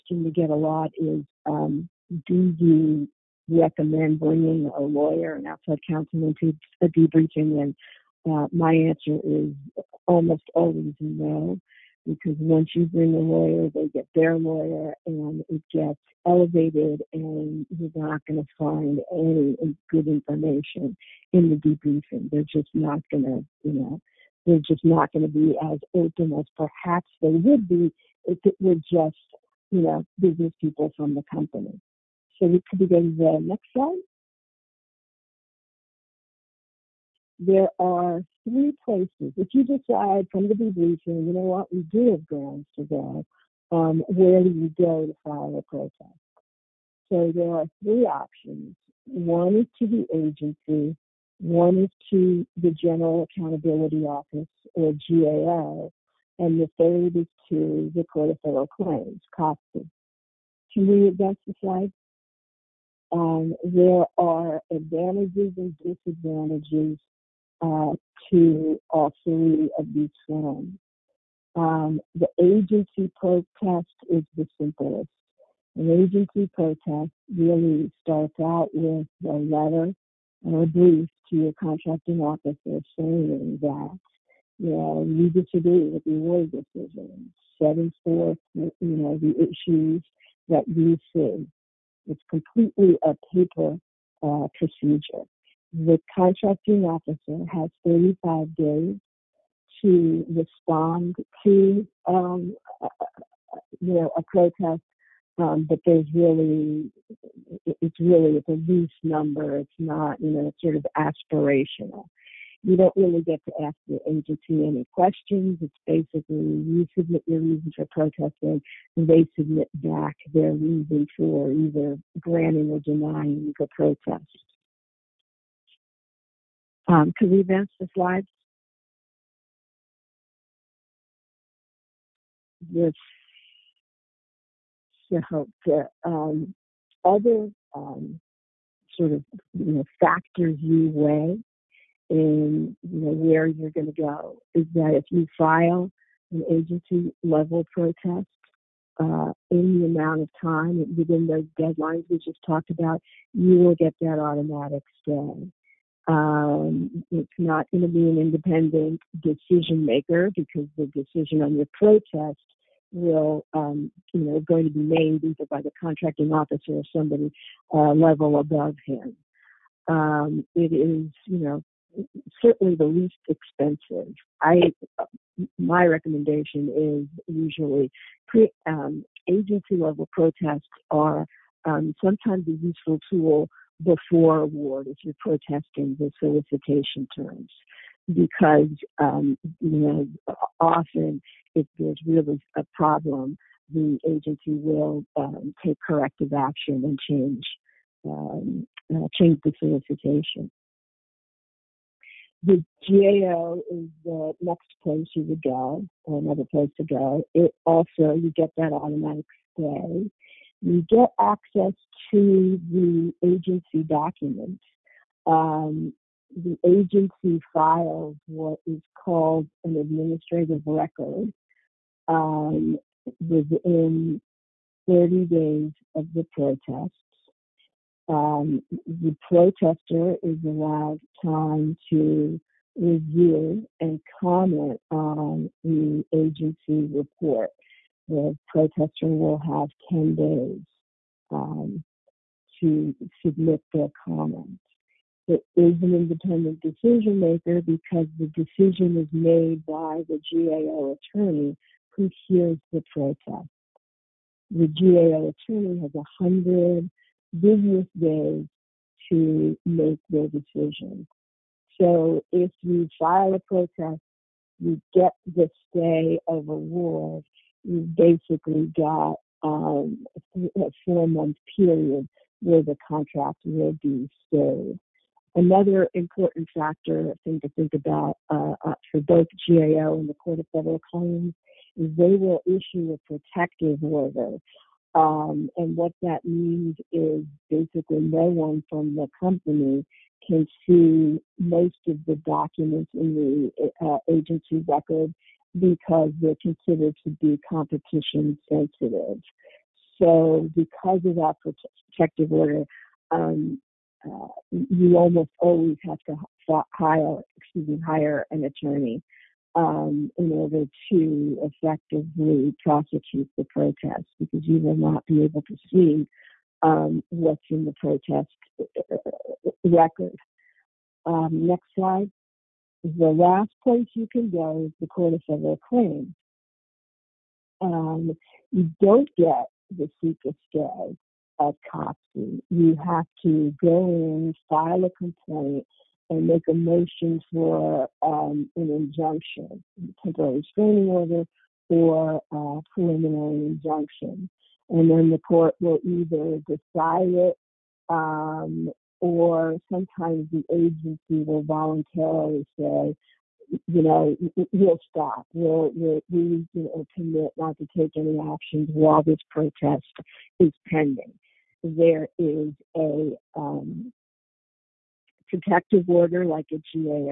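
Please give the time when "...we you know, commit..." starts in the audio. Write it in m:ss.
5:56.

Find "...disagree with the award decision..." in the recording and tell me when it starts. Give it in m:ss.
1:25.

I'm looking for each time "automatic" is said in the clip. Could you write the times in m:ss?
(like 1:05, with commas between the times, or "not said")
2:34, 3:28.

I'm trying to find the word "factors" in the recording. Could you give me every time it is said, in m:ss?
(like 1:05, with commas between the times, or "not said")
2:20, 4:36.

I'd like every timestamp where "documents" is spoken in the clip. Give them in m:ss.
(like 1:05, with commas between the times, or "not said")
3:33, 4:52.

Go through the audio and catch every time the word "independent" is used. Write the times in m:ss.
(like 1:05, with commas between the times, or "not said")
2:38, 4:05.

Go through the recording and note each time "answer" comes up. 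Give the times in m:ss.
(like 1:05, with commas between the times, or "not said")
0:08.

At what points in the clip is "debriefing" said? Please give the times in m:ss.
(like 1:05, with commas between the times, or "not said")
0:06, 0:21, 0:40.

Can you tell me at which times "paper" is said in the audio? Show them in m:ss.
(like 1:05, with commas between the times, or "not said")
1:33.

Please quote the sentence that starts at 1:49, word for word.
It's not, you know, sort of aspirational.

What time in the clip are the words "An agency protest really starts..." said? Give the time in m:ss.
1:15.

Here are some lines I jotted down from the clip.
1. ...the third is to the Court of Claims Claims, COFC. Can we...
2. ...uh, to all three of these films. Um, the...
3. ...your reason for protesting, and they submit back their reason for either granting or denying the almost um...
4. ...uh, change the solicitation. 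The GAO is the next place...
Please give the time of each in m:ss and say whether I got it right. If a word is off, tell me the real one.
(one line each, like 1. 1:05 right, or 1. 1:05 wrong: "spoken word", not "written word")
1. 0:56 wrong: "Federal", not "Claims"
2. 1:07 right
3. 1:57 wrong: "protest", not "almost"
4. 3:18 right.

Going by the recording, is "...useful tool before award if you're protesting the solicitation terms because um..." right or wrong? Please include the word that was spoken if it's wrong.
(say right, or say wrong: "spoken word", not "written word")
right.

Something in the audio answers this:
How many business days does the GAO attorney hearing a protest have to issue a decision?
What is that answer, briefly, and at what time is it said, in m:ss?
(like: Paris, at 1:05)
100 business days, at 4:15.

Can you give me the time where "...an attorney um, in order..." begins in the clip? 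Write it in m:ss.
5:08.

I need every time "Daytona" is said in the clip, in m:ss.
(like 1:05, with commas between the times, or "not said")
not said.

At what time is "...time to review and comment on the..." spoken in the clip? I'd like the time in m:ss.
3:51.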